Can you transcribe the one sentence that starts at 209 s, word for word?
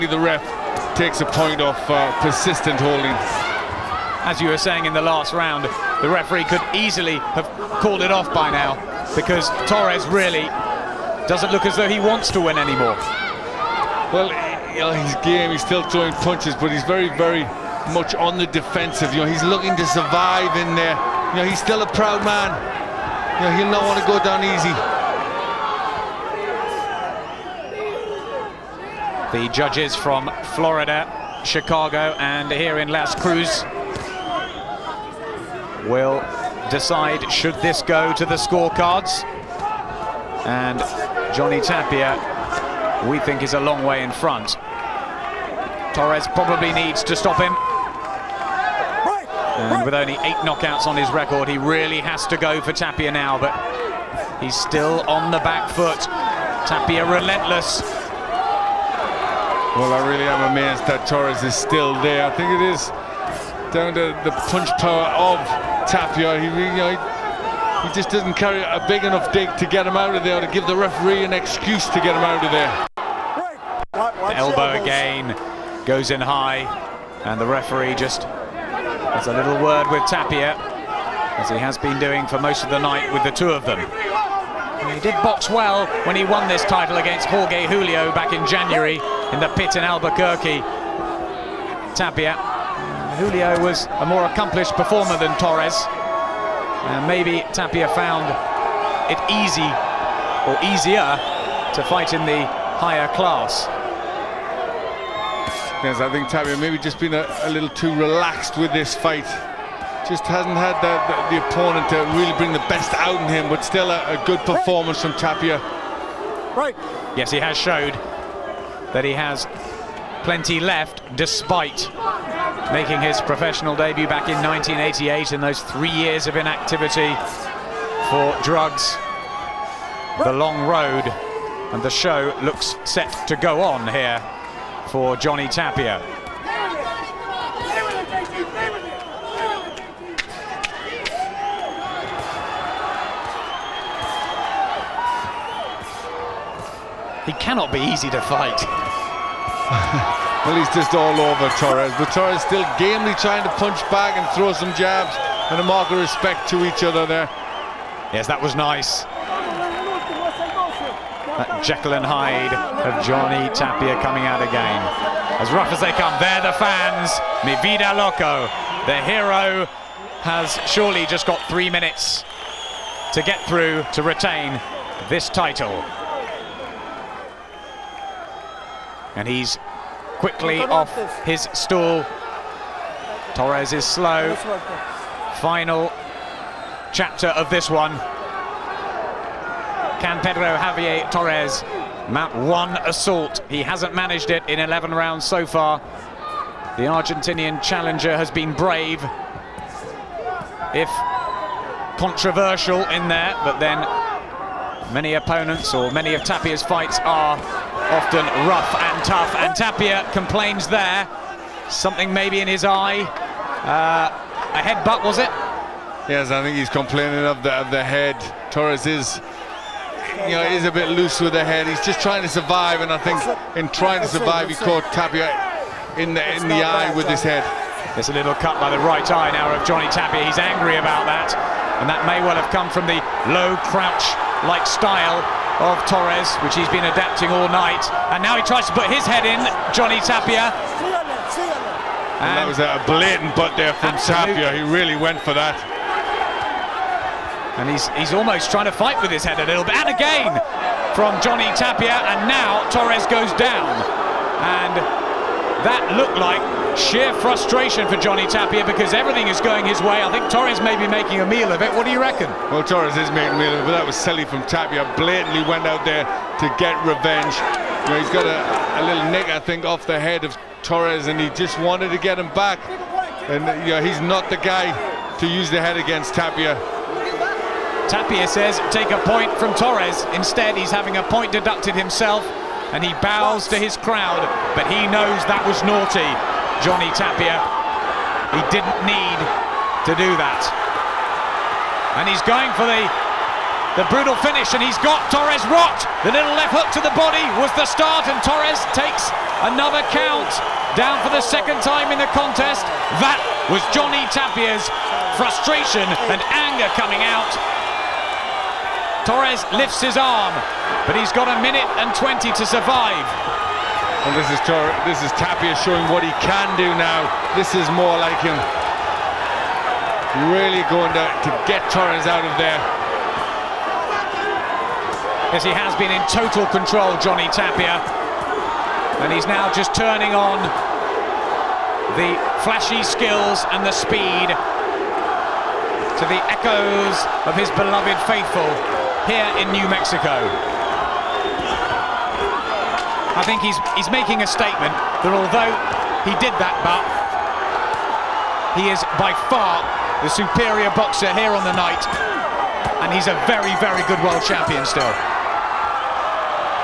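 And Tapia complains there, something maybe in his eye.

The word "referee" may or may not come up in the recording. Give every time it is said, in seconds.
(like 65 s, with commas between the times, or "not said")
6 s, 70 s, 77 s.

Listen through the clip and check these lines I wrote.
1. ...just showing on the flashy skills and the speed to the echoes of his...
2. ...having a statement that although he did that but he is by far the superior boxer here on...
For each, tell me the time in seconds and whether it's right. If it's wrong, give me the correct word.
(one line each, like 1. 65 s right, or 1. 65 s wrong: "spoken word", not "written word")
1. 329 s wrong: "turning", not "showing"
2. 343 s wrong: "making", not "having".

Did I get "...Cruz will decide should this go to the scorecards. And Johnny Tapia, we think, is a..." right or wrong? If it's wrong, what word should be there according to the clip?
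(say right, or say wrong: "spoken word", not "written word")
right.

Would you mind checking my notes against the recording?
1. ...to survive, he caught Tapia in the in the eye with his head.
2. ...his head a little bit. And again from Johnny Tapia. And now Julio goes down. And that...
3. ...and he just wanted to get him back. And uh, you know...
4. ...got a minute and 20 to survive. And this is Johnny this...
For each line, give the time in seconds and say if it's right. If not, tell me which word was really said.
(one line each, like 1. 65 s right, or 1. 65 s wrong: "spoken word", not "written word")
1. 224 s right
2. 249 s wrong: "Torres", not "Julio"
3. 271 s right
4. 311 s wrong: "Tor", not "Johnny".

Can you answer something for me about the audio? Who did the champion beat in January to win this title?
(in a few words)
Jorge Julio.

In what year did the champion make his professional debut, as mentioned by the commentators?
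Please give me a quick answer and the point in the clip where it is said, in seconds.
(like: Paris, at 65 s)
1988, at 124 s.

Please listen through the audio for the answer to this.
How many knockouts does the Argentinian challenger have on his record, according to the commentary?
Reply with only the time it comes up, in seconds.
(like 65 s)
50 s.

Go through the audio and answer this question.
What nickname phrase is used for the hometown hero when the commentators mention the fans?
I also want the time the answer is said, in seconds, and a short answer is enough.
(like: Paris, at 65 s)
Mi vida loco, at 167 s.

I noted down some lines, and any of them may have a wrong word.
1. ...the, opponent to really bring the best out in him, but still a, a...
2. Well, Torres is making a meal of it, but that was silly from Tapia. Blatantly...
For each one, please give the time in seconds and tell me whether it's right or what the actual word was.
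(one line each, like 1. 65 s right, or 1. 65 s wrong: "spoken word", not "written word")
1. 111 s right
2. 262 s right.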